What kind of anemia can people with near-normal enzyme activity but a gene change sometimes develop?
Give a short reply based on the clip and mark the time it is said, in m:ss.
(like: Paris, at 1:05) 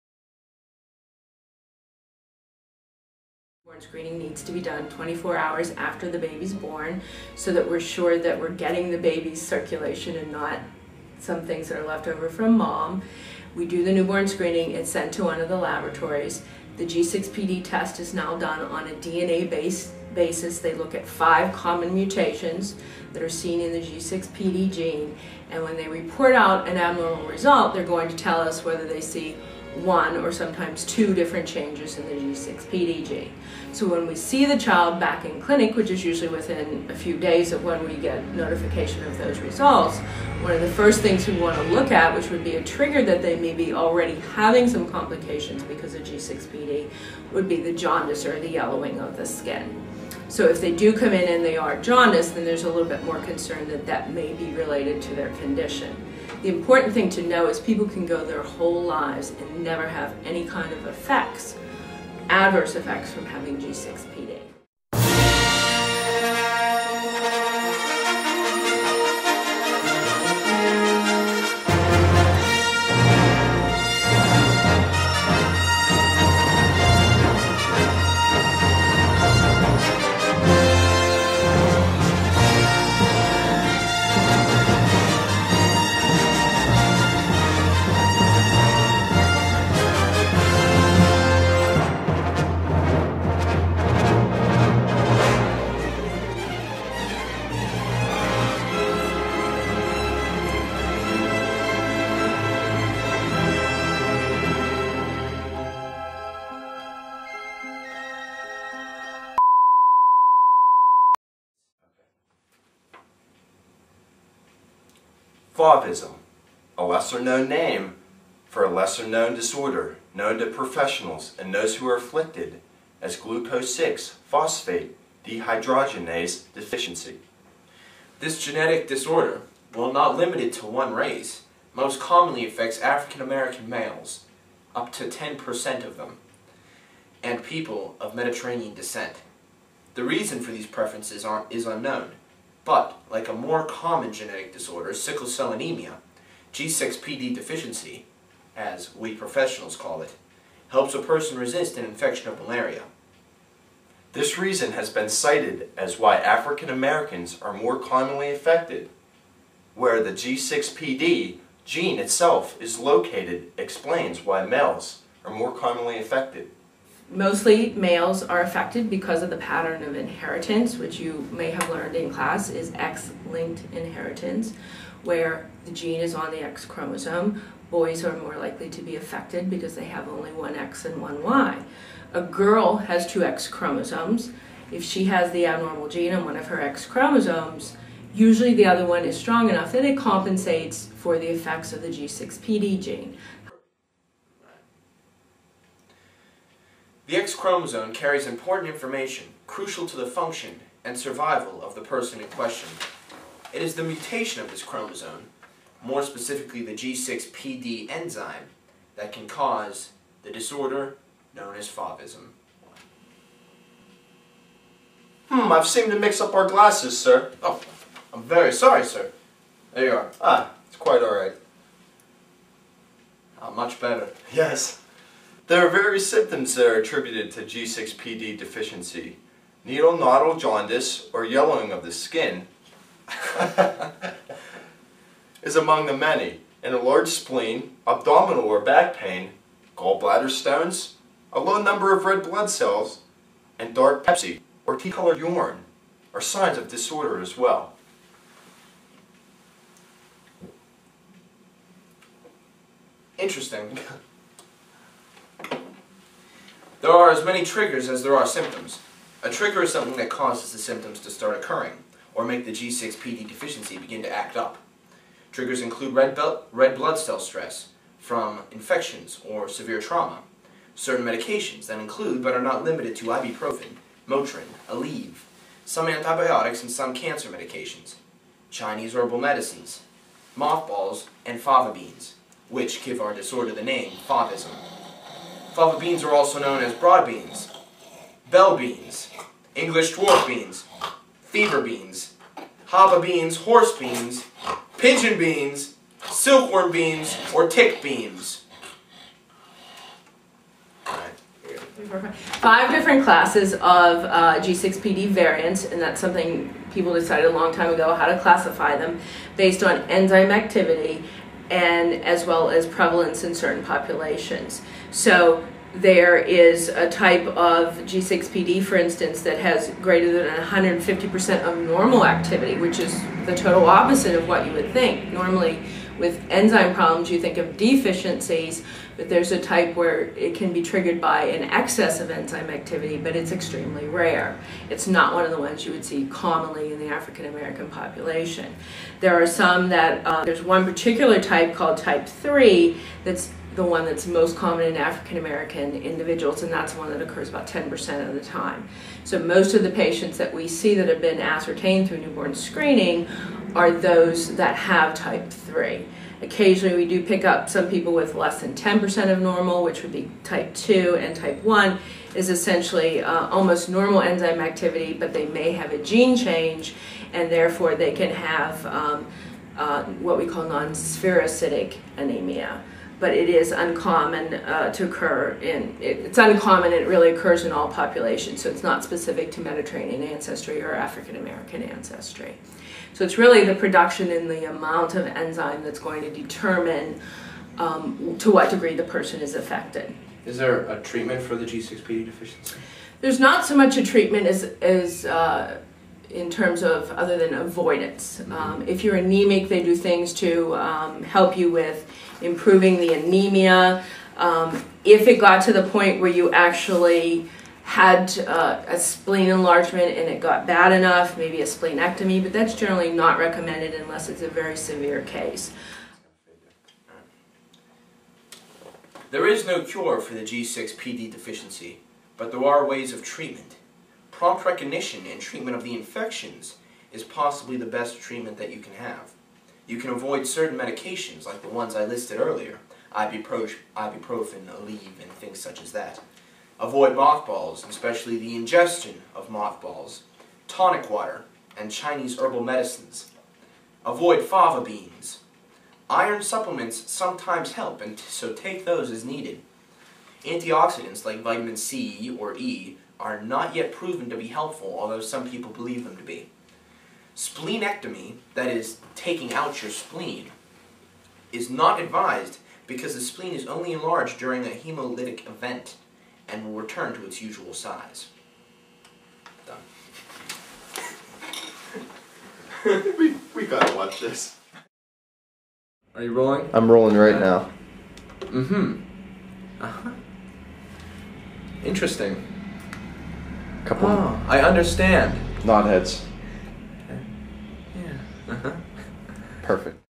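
Non-spherocytic anemia, at 6:10.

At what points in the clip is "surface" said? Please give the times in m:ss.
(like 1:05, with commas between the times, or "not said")
not said.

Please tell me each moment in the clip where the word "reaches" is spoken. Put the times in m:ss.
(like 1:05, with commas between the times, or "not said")
not said.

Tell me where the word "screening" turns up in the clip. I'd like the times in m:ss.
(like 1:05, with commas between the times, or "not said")
0:03, 0:14, 5:52.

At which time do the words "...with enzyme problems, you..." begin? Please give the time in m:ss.
5:25.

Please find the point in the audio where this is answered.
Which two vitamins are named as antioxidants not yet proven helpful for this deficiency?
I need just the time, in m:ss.
7:31.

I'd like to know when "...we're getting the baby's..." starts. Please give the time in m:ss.
0:08.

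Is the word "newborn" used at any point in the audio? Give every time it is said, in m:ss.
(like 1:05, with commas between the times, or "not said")
0:13, 5:51.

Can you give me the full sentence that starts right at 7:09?
You can avoid certain medications, like the ones I listed earlier, ibuprofen, Aleve, and things such as that.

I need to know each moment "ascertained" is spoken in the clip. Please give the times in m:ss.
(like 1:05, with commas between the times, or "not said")
5:51.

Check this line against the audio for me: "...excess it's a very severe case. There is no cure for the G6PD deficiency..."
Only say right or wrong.
wrong.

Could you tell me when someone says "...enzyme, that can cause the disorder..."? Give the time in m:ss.
3:27.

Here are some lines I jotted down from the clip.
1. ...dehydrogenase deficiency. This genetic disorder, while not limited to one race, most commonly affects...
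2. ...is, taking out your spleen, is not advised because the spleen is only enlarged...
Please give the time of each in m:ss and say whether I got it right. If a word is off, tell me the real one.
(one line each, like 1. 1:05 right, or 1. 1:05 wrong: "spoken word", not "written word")
1. 2:05 right
2. 7:38 right.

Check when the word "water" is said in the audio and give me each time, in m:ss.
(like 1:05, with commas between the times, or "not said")
7:20.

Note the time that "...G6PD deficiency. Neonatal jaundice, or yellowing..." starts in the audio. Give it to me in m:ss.
3:47.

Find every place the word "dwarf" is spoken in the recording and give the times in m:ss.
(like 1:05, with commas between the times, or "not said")
4:49.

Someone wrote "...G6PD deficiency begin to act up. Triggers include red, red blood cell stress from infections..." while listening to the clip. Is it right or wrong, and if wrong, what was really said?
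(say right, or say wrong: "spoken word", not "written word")
right.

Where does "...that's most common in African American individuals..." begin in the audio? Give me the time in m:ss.
5:43.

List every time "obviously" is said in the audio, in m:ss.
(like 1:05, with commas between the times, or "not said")
not said.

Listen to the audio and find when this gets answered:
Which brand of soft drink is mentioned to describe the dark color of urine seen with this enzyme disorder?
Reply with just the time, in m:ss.
4:04.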